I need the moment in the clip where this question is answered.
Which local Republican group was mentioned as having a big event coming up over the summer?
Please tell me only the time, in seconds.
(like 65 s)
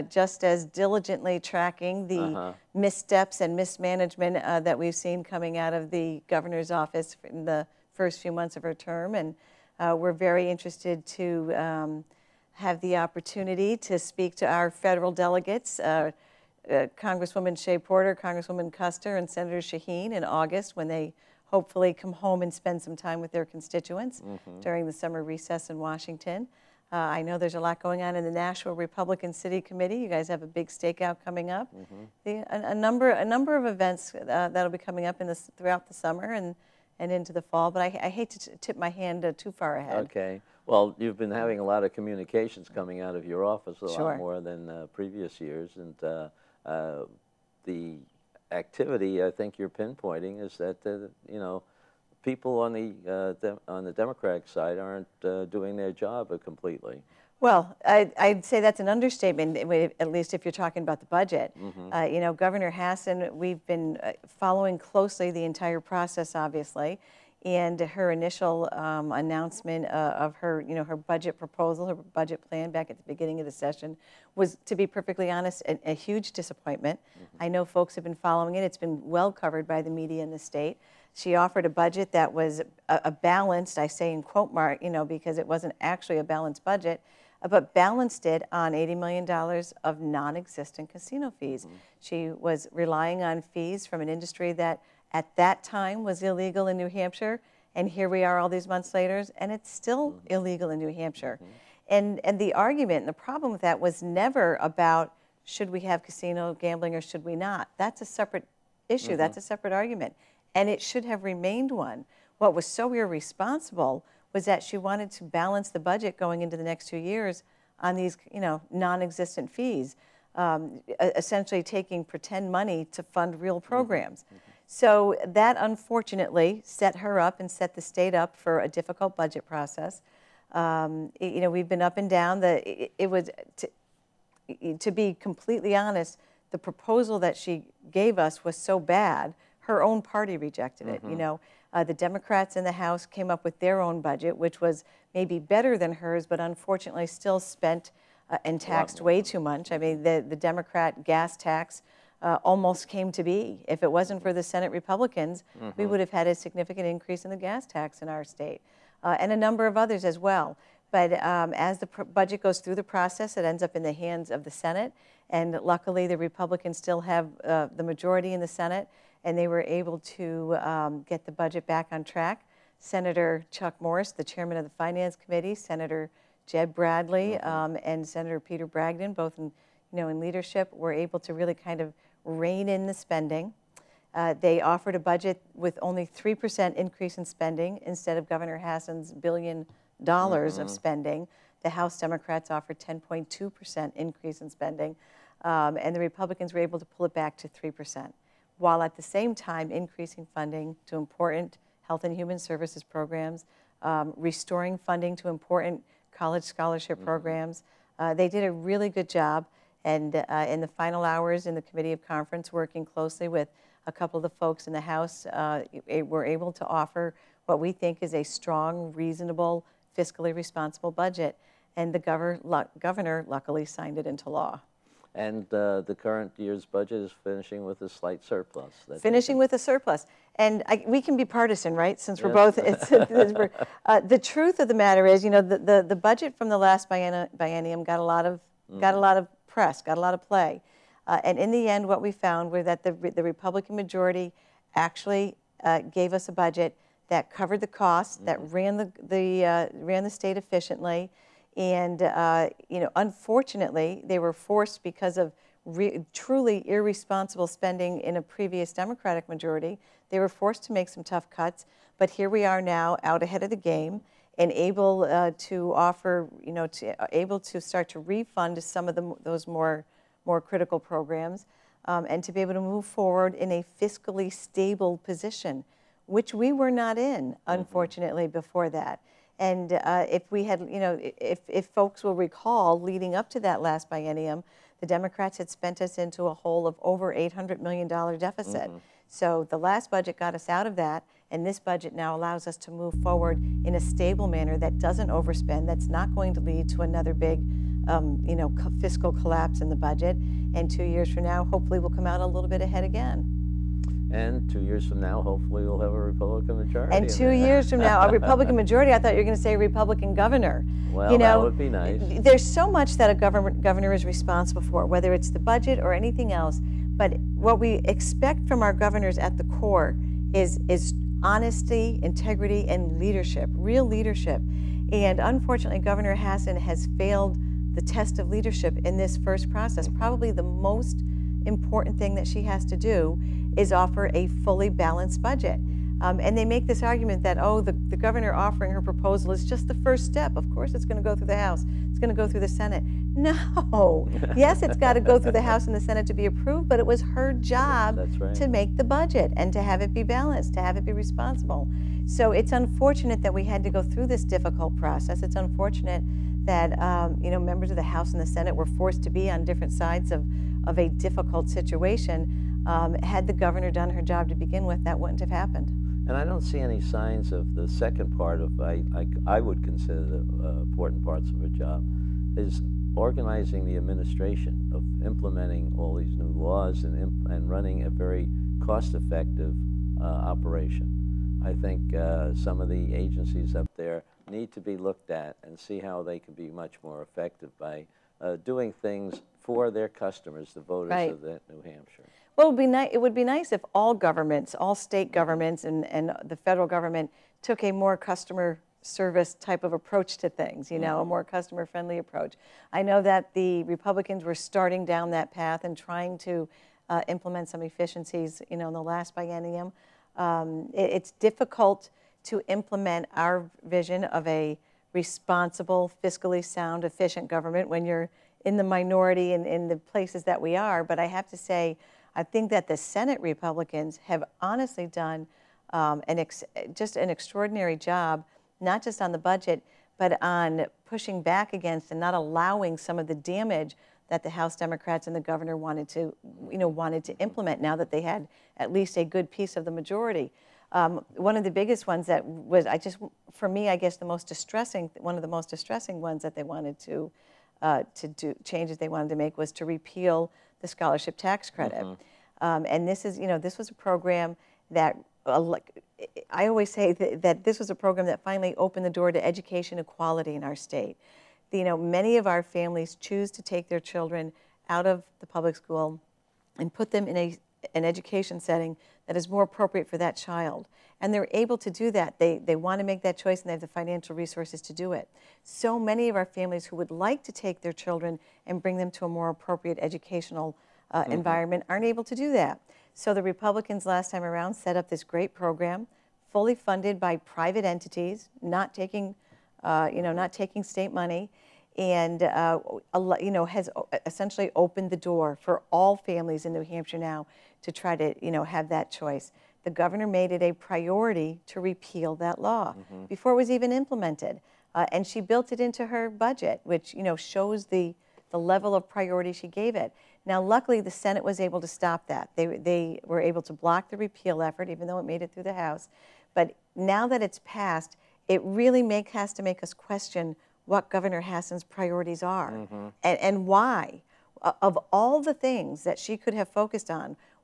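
28 s.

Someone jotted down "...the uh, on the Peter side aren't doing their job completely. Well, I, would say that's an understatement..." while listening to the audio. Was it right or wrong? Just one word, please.
wrong.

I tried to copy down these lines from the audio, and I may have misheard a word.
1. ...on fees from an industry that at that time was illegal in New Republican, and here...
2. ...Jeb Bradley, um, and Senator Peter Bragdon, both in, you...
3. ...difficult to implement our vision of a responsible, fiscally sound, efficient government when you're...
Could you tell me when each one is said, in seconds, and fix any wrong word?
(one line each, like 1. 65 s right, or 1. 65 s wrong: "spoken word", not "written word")
1. 93 s wrong: "Hampshire", not "Republican"
2. 176 s right
3. 411 s right.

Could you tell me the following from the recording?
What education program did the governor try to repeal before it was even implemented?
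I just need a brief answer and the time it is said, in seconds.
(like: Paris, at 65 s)
scholarship tax credit, at 450 s.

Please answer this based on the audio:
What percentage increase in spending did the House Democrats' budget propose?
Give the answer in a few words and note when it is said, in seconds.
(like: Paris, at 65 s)
10.2%, at 192 s.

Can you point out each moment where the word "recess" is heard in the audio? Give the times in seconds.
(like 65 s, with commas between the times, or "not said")
25 s.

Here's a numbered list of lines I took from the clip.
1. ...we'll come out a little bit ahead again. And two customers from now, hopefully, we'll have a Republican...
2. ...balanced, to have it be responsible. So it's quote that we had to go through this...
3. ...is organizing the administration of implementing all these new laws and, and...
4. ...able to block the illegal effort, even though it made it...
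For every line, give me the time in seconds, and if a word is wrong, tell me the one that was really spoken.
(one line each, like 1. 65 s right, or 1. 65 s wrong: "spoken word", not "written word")
1. 301 s wrong: "years", not "customers"
2. 350 s wrong: "unfortunate", not "quote"
3. 372 s right
4. 513 s wrong: "repeal", not "illegal".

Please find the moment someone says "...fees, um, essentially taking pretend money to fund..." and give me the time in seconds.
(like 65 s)
119 s.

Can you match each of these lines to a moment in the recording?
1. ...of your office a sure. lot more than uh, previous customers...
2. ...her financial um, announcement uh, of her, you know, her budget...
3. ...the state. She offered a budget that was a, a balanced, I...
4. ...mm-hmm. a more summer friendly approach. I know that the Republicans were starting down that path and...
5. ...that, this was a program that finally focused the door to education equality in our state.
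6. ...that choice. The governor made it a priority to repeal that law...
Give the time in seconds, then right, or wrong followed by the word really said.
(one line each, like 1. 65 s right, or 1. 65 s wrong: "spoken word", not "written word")
1. 43 s wrong: "years", not "customers"
2. 67 s wrong: "initial", not "financial"
3. 80 s right
4. 400 s wrong: "customer", not "summer"
5. 457 s wrong: "opened", not "focused"
6. 498 s right.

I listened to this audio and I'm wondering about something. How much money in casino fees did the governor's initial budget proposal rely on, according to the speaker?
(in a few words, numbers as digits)
$80 million.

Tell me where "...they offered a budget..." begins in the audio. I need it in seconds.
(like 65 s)
184 s.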